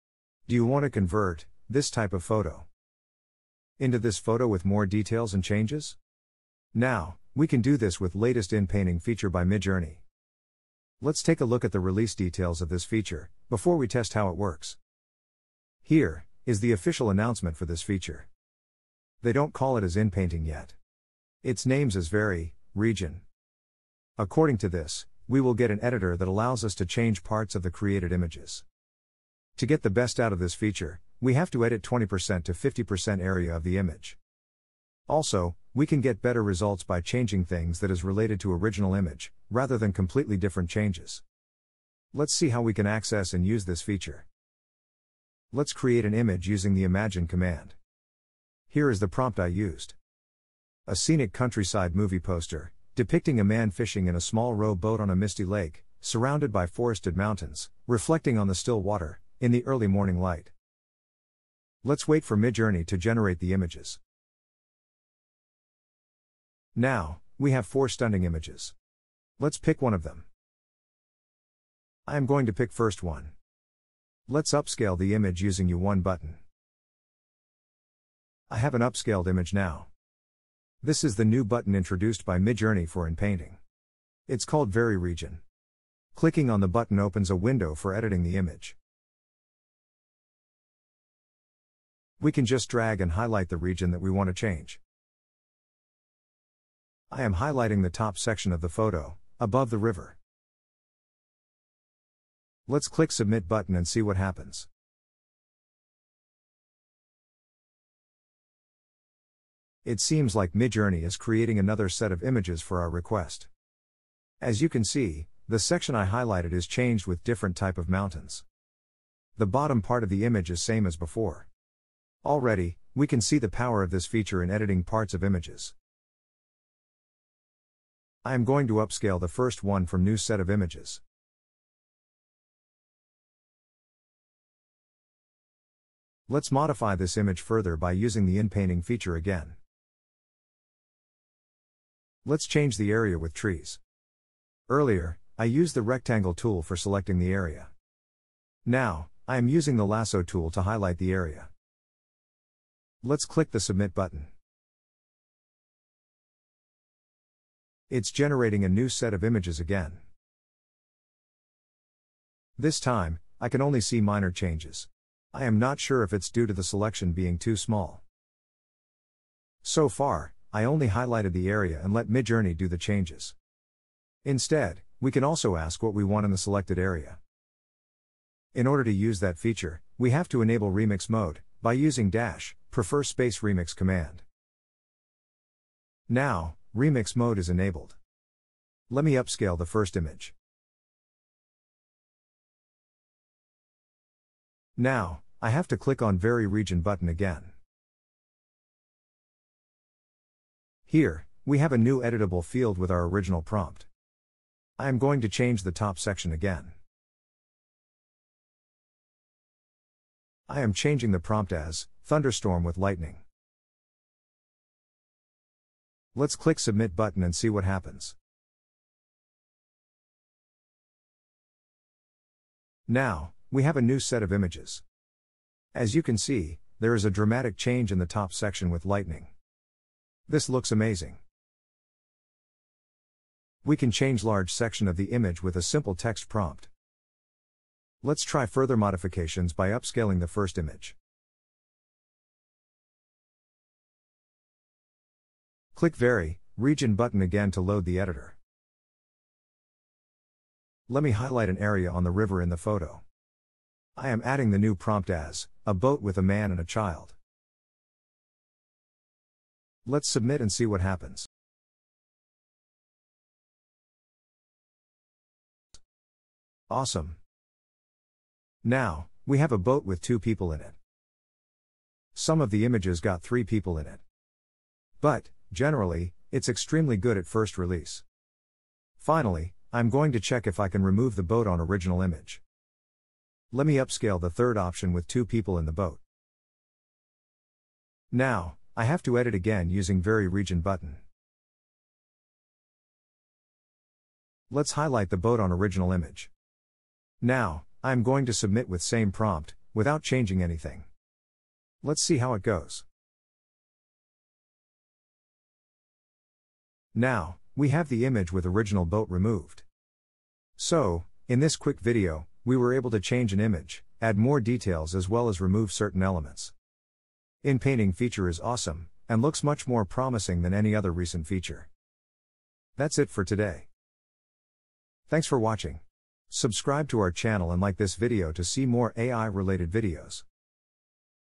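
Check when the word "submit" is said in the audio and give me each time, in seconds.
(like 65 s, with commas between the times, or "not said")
103 s, 153 s, 216 s, 260 s, 298 s.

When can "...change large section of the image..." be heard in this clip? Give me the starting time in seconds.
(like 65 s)
233 s.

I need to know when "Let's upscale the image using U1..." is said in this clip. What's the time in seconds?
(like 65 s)
74 s.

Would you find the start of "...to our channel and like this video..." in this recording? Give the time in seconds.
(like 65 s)
326 s.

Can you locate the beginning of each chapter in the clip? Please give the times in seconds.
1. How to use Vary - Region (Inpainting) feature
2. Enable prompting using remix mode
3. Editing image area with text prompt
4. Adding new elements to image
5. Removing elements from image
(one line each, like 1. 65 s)
1. 44 s
2. 177 s
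3. 201 s
4. 238 s
5. 279 s.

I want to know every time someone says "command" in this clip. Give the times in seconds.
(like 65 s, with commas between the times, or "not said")
47 s, 183 s.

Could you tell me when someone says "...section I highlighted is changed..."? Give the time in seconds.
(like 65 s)
115 s.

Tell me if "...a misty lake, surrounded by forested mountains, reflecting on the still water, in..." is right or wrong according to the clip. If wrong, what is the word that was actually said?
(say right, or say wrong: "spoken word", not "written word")
right.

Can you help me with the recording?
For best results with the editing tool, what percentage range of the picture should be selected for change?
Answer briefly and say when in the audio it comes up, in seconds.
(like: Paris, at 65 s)
20% to 50%, at 31 s.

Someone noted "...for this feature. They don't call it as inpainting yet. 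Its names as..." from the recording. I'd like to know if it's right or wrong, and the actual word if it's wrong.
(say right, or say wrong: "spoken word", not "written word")
right.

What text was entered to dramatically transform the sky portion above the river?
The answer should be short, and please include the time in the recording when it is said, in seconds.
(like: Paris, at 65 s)
thunderstorm with lightning, at 212 s.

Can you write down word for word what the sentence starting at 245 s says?
Click Vary, Region button again to load the editor.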